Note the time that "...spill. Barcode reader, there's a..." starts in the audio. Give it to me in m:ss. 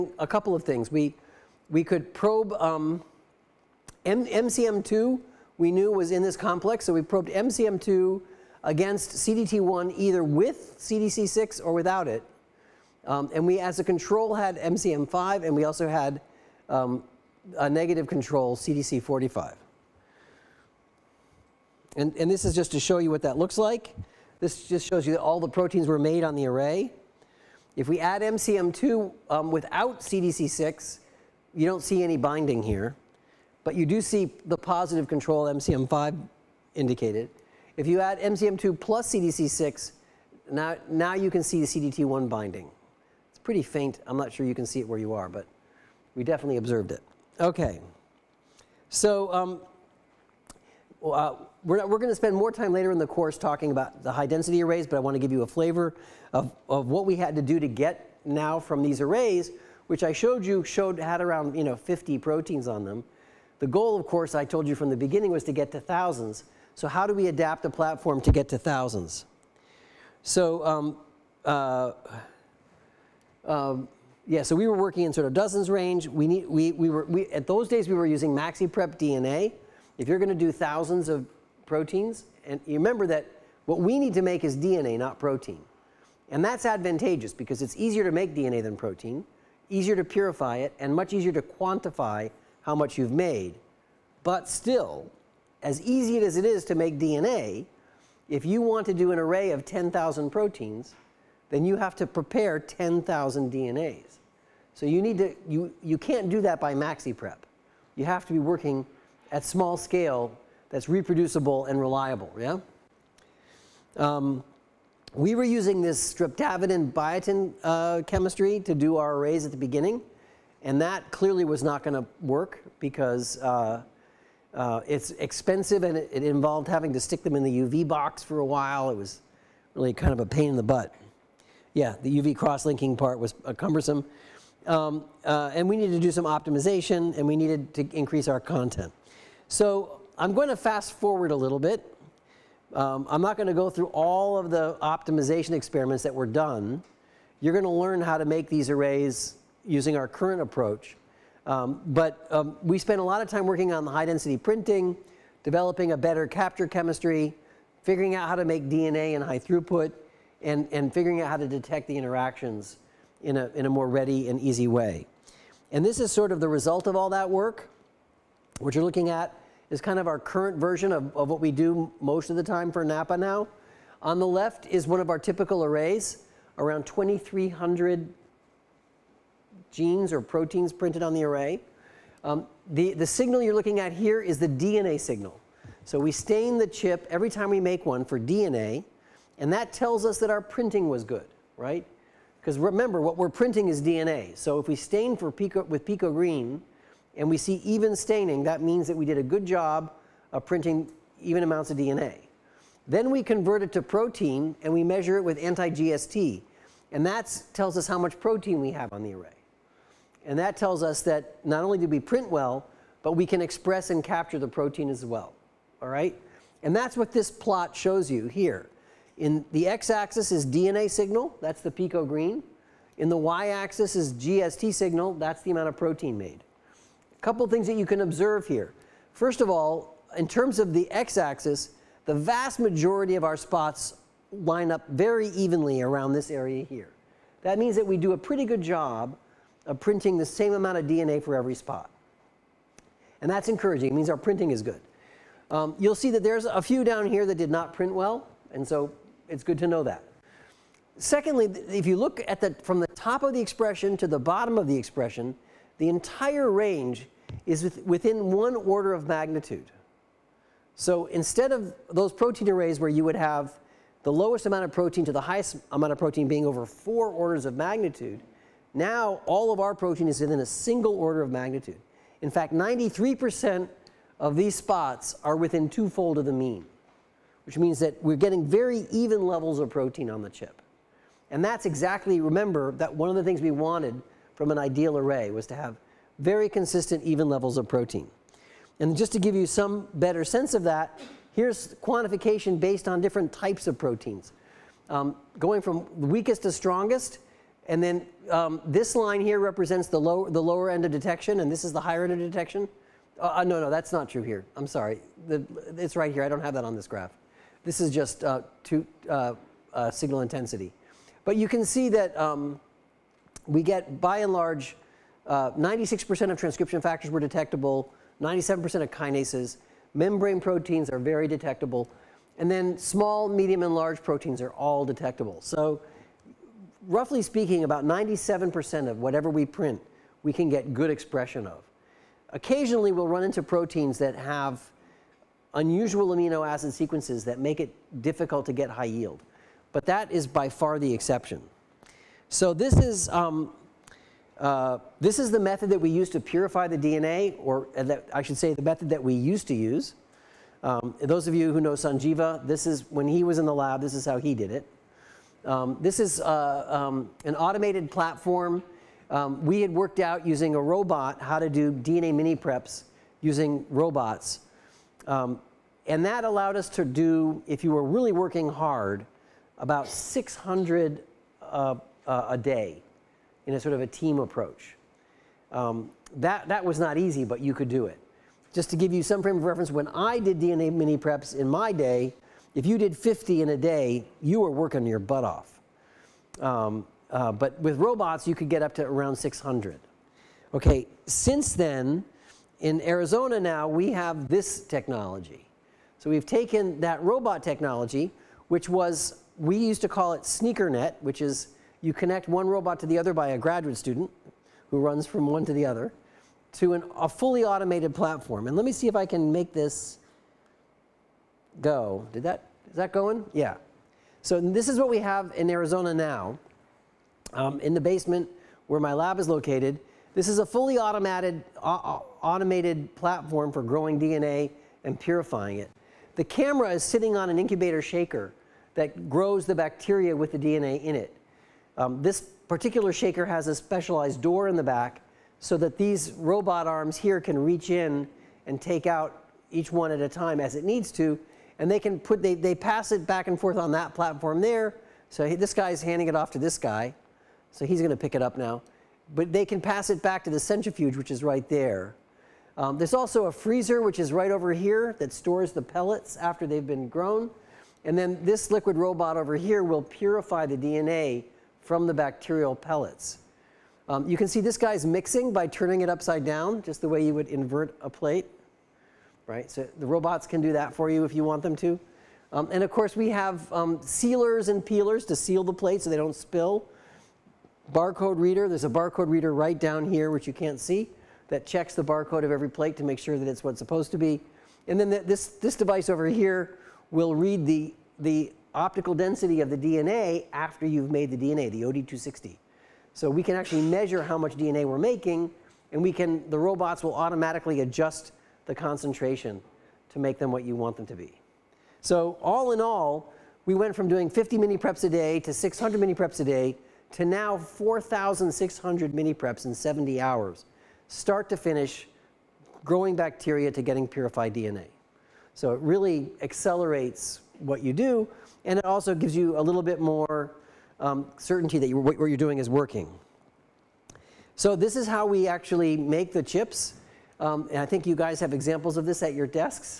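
7:56.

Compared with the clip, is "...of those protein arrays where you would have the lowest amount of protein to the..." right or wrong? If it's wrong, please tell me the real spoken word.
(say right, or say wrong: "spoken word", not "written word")
right.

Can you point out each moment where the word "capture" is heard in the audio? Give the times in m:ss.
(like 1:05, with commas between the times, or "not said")
2:36, 3:34.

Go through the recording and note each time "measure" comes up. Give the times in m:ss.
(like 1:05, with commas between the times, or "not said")
3:24, 8:13.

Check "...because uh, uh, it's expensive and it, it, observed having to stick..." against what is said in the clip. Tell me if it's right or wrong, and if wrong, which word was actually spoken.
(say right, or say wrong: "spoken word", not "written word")
wrong: "involved", not "observed".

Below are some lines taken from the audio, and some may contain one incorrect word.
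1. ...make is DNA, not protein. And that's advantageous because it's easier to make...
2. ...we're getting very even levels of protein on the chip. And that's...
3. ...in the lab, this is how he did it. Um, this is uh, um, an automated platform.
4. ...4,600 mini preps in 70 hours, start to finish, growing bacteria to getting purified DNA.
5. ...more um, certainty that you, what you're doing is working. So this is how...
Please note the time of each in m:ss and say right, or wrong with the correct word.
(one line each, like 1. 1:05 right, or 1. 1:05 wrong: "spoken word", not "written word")
1. 1:24 right
2. 4:38 right
3. 5:53 right
4. 8:27 right
5. 8:39 right.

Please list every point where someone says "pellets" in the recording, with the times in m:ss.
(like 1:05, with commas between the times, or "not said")
7:35, 7:42.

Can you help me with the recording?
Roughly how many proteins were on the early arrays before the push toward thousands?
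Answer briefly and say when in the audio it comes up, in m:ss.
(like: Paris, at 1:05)
50, at 1:01.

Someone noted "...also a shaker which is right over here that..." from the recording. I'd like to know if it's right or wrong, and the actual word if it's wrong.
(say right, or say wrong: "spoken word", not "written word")
wrong: "freezer", not "shaker".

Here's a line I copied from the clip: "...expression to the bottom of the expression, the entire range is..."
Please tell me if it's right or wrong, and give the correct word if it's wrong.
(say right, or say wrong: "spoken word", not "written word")
right.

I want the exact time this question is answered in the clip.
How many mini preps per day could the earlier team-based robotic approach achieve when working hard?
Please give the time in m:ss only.
6:09.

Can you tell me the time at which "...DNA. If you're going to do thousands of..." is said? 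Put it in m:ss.
1:19.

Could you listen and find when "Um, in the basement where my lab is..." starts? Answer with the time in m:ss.
6:57.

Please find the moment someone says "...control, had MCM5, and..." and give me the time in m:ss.
0:13.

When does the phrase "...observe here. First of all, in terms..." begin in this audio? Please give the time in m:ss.
3:48.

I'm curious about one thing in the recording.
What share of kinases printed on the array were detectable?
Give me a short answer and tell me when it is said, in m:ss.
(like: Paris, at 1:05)
97%, at 5:18.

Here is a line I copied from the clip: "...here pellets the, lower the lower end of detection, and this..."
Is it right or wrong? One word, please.
wrong.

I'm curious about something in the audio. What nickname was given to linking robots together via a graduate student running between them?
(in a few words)
SneakerNet.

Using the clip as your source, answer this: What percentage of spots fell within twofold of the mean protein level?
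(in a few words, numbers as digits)
93%.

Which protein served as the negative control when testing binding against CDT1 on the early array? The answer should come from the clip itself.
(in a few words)
CDC45.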